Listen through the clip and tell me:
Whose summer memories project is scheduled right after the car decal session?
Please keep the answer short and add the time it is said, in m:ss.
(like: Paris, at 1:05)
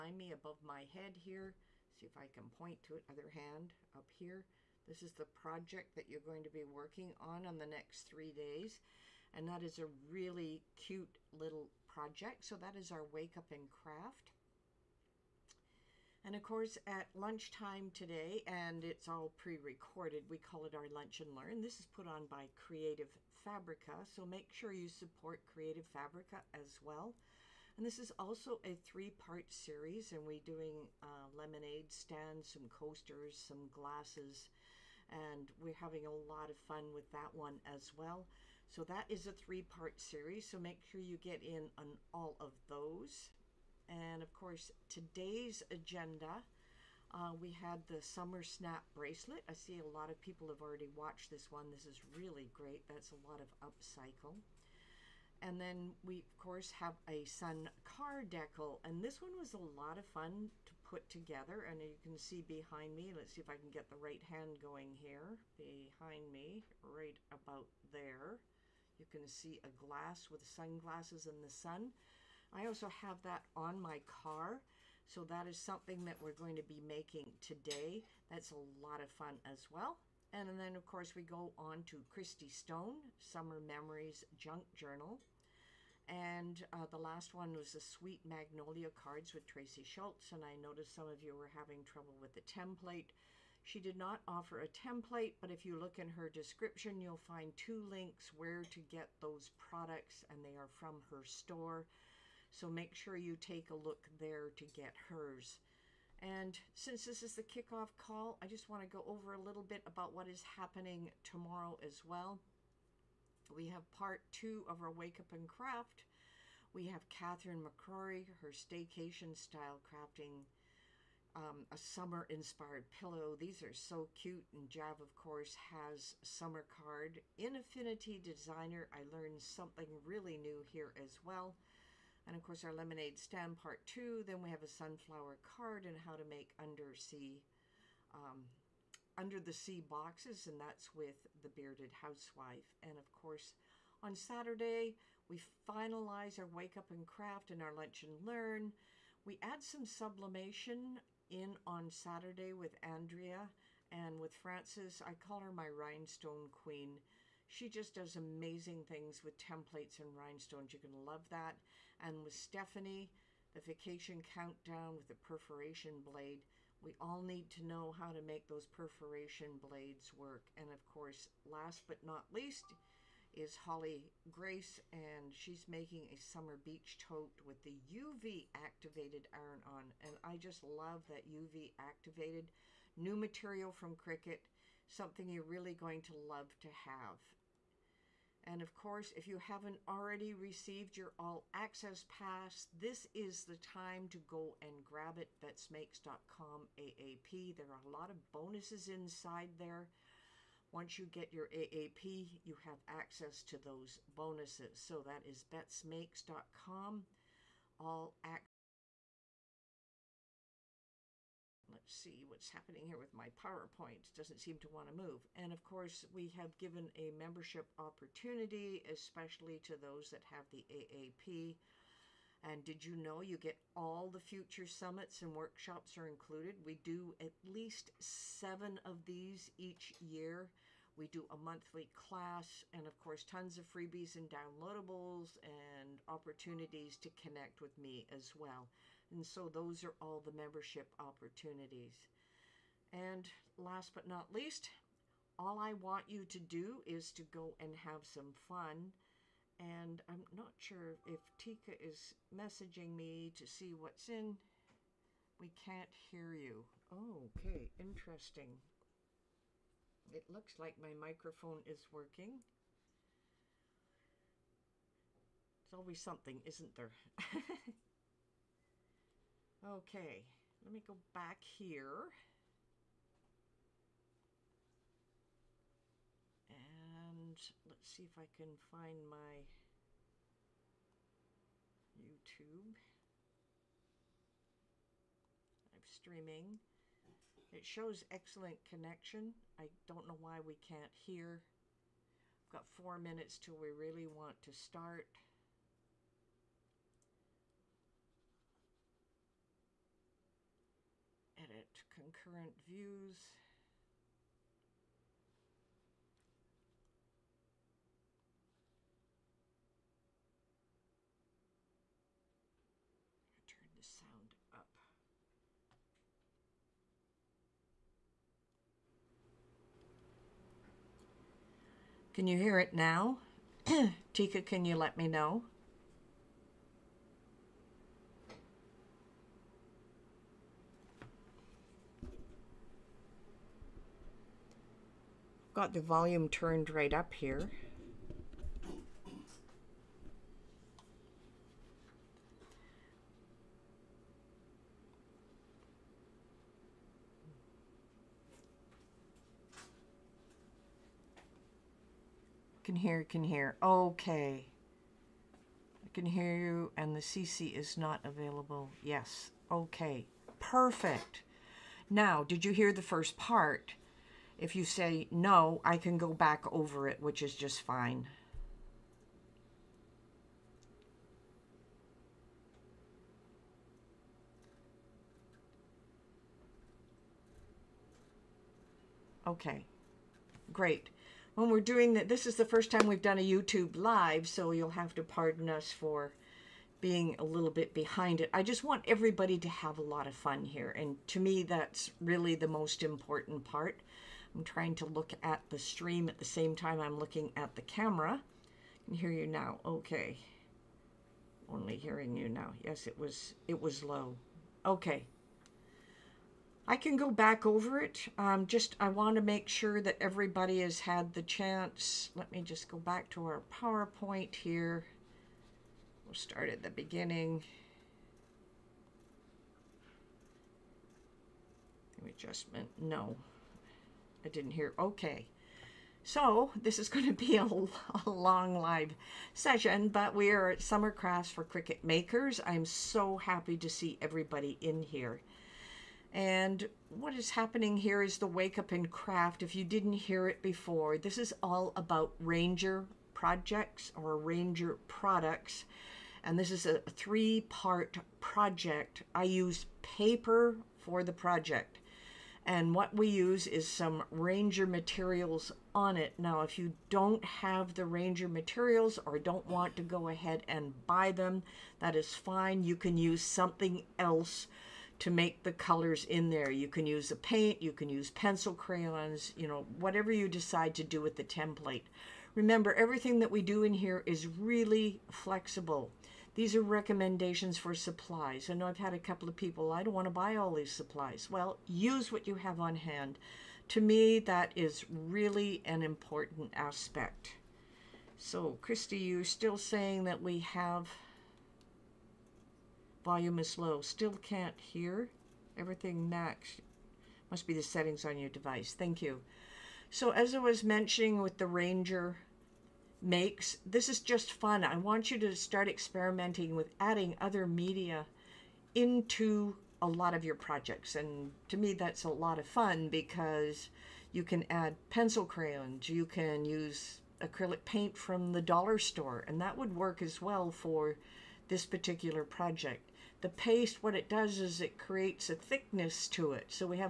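Christy Stone, at 1:22.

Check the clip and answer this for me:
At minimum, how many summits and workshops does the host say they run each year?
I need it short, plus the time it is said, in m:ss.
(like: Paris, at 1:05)
7, at 3:47.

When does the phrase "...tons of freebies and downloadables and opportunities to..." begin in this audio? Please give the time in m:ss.
3:53.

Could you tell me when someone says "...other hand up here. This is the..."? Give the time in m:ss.
0:03.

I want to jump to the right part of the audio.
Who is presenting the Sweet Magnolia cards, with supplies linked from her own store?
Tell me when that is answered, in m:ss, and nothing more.
1:29.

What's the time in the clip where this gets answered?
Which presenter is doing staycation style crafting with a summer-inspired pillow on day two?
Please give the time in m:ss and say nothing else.
1:57.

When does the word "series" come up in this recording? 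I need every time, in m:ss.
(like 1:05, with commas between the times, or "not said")
0:29, 0:39.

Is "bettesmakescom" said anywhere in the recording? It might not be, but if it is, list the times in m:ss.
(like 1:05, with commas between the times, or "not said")
3:15, 3:25.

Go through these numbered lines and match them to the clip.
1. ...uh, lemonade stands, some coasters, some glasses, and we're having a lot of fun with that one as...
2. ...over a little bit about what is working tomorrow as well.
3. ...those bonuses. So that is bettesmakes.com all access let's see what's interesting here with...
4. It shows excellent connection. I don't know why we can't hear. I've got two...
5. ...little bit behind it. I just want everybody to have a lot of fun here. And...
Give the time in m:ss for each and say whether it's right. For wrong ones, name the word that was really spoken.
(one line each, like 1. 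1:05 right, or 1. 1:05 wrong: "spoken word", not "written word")
1. 0:31 right
2. 1:49 wrong: "happening", not "working"
3. 3:23 wrong: "happening", not "interesting"
4. 4:47 wrong: "four", not "two"
5. 6:27 right.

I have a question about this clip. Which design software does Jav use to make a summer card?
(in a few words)
Affinity Designer.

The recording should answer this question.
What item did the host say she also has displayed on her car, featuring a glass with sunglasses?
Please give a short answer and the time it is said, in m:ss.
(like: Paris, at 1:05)
sun car decal, at 0:57.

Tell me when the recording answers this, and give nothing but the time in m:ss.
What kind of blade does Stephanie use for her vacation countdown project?
2:45.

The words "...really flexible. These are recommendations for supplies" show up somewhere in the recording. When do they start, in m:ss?
7:54.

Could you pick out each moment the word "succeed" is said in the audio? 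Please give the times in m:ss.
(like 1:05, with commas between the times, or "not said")
not said.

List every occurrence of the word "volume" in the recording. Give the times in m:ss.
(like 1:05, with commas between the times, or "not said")
5:35, 8:13.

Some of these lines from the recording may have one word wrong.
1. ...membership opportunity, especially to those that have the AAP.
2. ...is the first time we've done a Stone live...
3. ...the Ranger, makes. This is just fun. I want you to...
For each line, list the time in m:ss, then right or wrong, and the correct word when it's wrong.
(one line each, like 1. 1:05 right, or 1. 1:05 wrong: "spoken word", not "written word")
1. 3:37 right
2. 6:22 wrong: "YouTube", not "Stone"
3. 8:21 right.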